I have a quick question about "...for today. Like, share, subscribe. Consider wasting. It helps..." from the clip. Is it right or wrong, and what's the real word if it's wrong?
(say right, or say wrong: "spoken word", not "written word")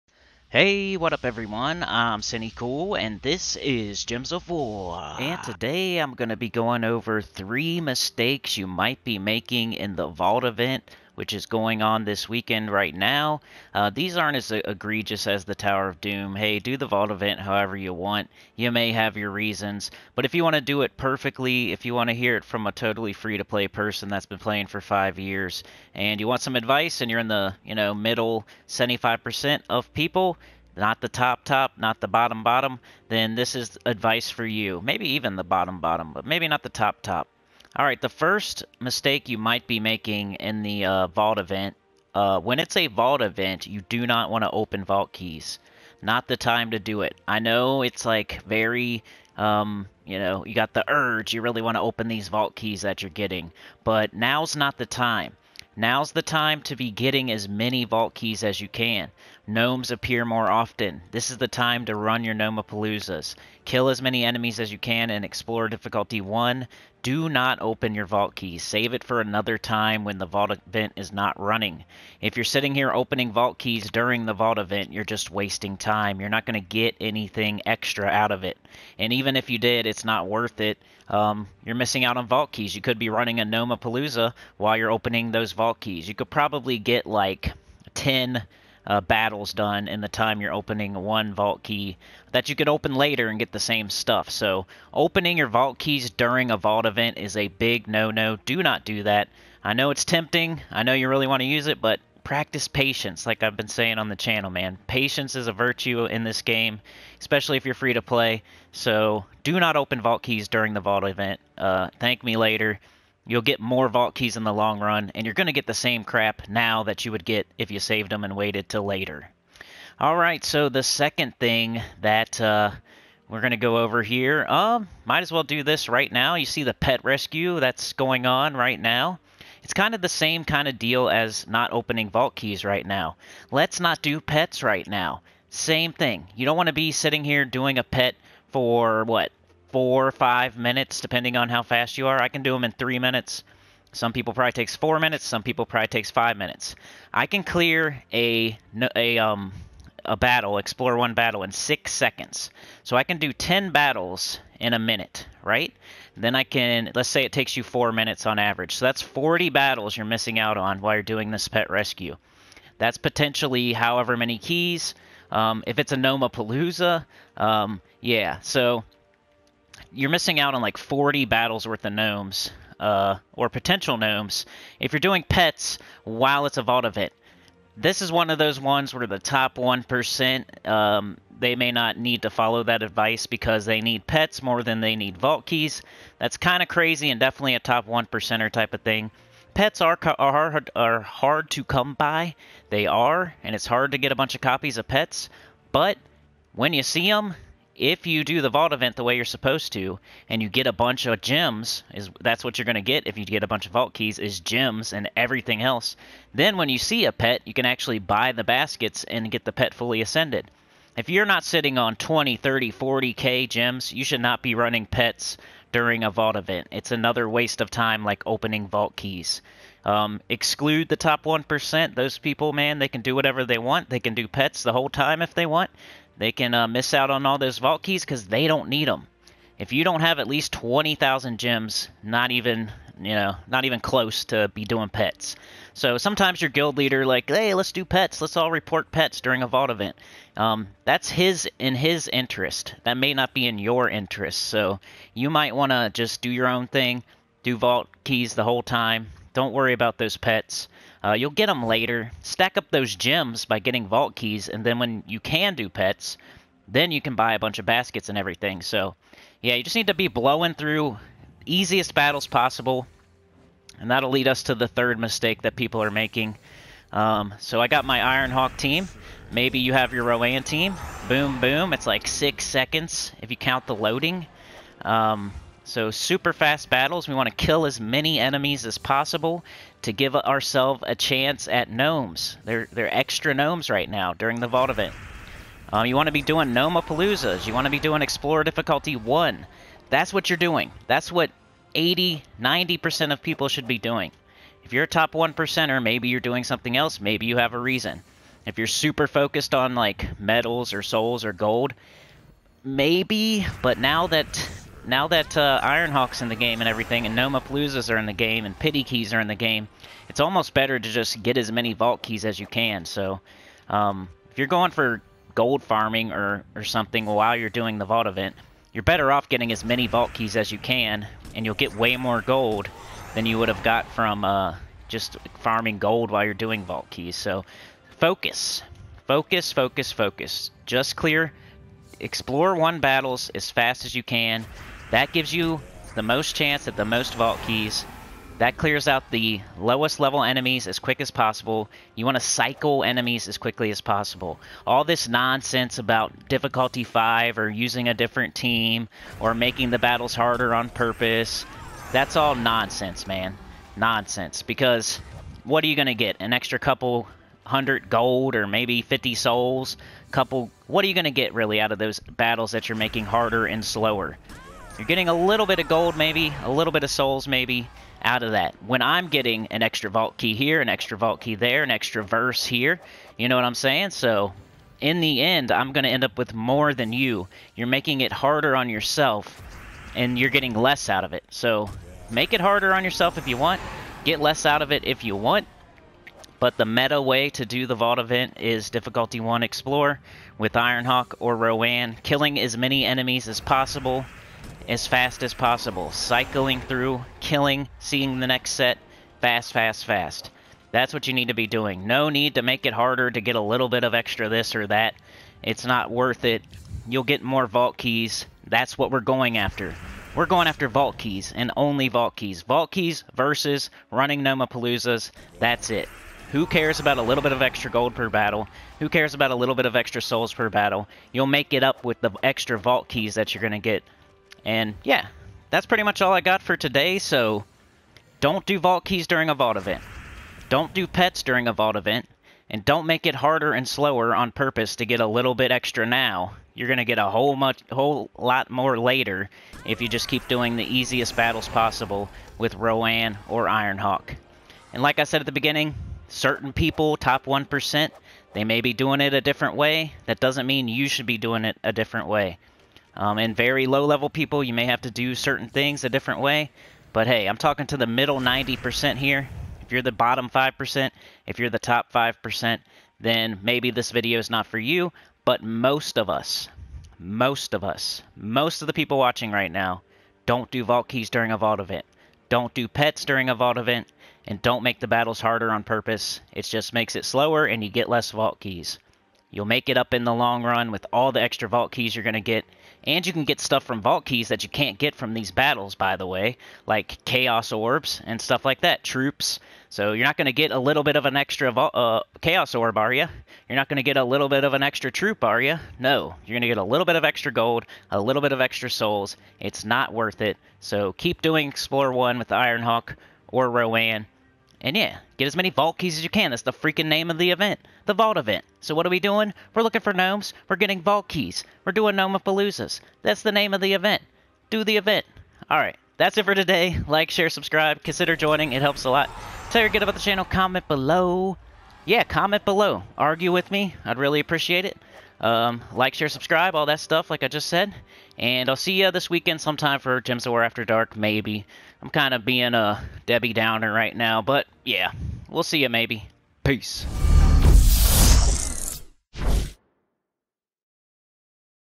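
wrong: "joining", not "wasting".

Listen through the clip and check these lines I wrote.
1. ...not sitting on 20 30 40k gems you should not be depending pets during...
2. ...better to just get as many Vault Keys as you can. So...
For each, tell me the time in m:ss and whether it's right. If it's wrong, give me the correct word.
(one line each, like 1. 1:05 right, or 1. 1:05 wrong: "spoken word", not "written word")
1. 3:31 wrong: "running", not "depending"
2. 5:10 right.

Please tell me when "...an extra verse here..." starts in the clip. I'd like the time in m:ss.
6:11.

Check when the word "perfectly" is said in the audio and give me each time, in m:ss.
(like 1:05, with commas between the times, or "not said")
0:20.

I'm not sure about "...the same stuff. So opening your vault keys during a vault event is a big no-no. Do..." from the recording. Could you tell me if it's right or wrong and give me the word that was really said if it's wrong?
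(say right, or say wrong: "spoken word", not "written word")
right.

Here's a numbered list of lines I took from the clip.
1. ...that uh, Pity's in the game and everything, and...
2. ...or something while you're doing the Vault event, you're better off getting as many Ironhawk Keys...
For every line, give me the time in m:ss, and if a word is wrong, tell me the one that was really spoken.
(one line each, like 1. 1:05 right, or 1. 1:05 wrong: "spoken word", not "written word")
1. 5:05 wrong: "Ironhawk", not "Pity"
2. 5:16 wrong: "Vault", not "Ironhawk".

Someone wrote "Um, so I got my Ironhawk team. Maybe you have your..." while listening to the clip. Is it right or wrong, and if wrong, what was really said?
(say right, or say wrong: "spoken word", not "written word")
right.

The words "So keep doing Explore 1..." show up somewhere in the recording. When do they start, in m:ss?
8:20.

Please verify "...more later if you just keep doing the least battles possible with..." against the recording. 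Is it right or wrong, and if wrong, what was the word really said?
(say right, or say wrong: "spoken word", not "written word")
wrong: "easiest", not "least".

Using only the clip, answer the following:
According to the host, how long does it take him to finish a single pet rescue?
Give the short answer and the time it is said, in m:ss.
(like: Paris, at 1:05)
3 minutes, at 2:22.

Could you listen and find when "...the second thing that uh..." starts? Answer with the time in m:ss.
2:00.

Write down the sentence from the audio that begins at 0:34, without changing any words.
Maybe even the bottom bottom, but maybe not the top top.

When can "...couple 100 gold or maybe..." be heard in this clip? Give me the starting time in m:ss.
5:56.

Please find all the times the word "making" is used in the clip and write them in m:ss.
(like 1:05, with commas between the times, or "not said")
0:09, 0:39, 4:25, 5:49, 6:02, 6:17.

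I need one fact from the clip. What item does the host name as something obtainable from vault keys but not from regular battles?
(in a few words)
Chaos orbs.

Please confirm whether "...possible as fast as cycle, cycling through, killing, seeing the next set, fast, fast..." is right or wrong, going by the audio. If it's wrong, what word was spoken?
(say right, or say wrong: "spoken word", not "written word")
wrong: "possible", not "cycle".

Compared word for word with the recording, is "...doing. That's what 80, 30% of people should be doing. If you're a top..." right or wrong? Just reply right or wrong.
wrong.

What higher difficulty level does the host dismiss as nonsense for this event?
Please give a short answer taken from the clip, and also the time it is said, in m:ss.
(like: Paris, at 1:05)
Difficulty 5, at 5:46.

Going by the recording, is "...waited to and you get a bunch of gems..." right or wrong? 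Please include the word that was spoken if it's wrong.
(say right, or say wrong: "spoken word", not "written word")
wrong: "supposed", not "waited".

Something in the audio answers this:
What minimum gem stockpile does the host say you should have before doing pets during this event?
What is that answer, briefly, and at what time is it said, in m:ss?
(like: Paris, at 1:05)
20,000, at 3:50.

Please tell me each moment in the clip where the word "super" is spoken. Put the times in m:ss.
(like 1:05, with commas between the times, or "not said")
4:35, 4:58.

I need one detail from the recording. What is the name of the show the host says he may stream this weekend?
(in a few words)
Gems of War After Dark.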